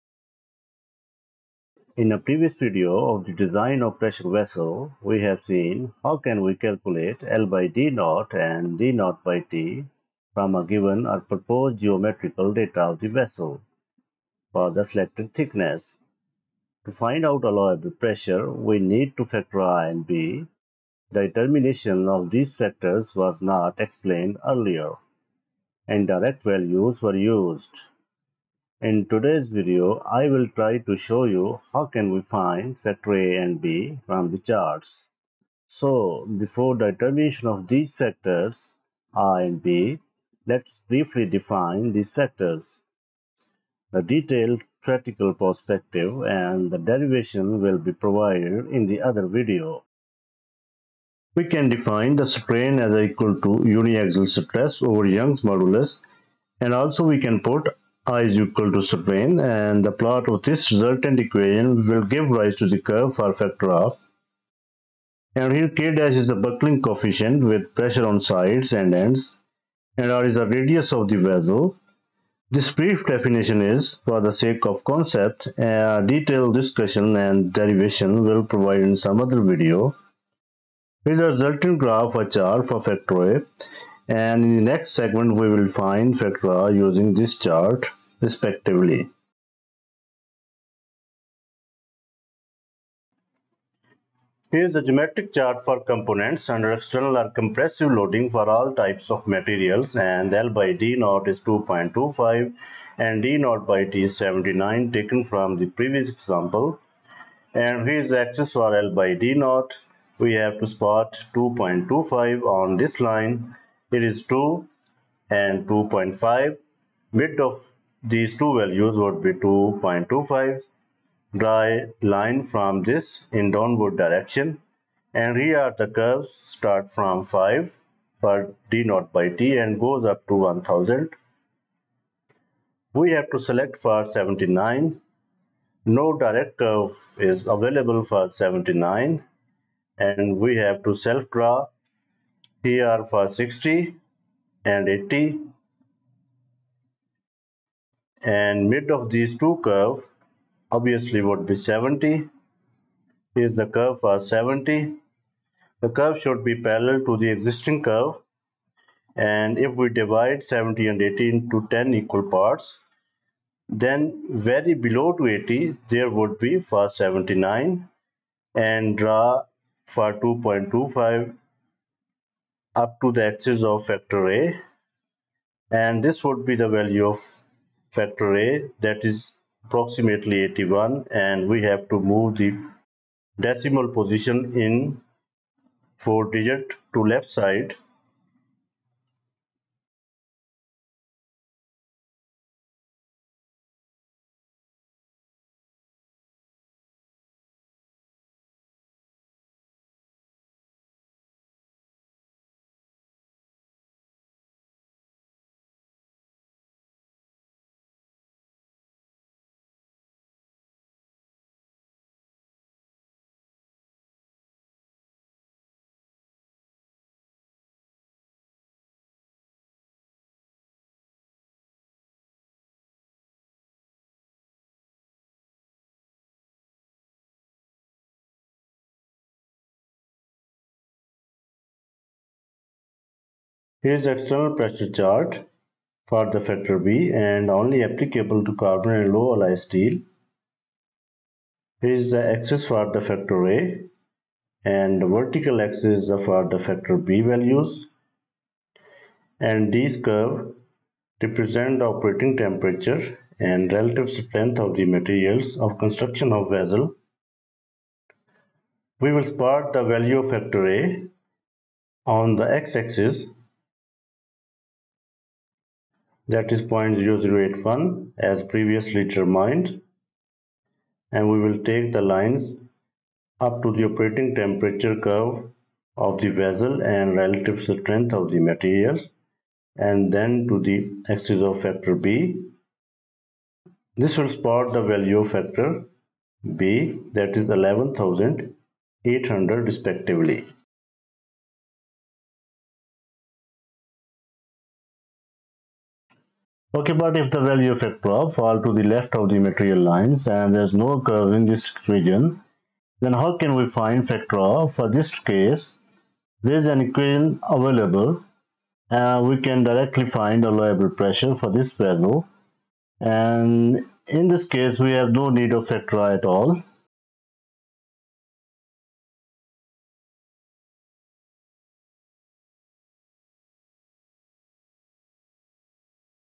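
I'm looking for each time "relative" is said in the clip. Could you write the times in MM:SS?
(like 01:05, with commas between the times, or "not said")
04:13, 04:37.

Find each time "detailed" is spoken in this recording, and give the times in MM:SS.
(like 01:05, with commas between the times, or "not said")
00:44, 01:16.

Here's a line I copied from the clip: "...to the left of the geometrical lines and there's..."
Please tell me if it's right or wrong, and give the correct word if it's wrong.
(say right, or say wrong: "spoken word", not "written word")
wrong: "material", not "geometrical".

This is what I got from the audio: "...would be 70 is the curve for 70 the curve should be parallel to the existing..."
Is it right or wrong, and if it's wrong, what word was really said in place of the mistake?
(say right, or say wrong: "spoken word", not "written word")
right.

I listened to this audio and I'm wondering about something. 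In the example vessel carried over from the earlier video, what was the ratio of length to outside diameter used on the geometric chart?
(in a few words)
2.25.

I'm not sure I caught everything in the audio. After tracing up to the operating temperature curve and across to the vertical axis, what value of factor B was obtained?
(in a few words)
11,800.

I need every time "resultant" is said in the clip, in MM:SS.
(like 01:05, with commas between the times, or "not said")
01:00, 01:21.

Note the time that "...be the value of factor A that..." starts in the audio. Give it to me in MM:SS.
02:56.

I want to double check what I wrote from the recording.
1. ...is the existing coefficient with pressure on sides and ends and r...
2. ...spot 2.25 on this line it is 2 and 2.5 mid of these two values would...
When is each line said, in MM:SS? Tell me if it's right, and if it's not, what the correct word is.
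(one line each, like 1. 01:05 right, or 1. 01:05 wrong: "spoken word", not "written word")
1. 01:06 wrong: "buckling", not "existing"
2. 01:50 right.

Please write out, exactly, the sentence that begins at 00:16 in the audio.
To find out allowable pressure, we need to factor A and B.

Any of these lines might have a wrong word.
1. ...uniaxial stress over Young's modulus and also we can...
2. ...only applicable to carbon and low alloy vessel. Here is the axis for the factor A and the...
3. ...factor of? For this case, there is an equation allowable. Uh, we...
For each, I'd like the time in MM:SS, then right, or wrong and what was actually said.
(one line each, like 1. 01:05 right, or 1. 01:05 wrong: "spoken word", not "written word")
1. 00:53 right
2. 03:57 wrong: "steel", not "vessel"
3. 05:04 wrong: "available", not "allowable".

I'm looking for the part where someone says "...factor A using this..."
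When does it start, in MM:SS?
01:26.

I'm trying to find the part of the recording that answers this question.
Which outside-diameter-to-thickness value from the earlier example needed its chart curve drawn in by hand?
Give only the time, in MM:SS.
01:43.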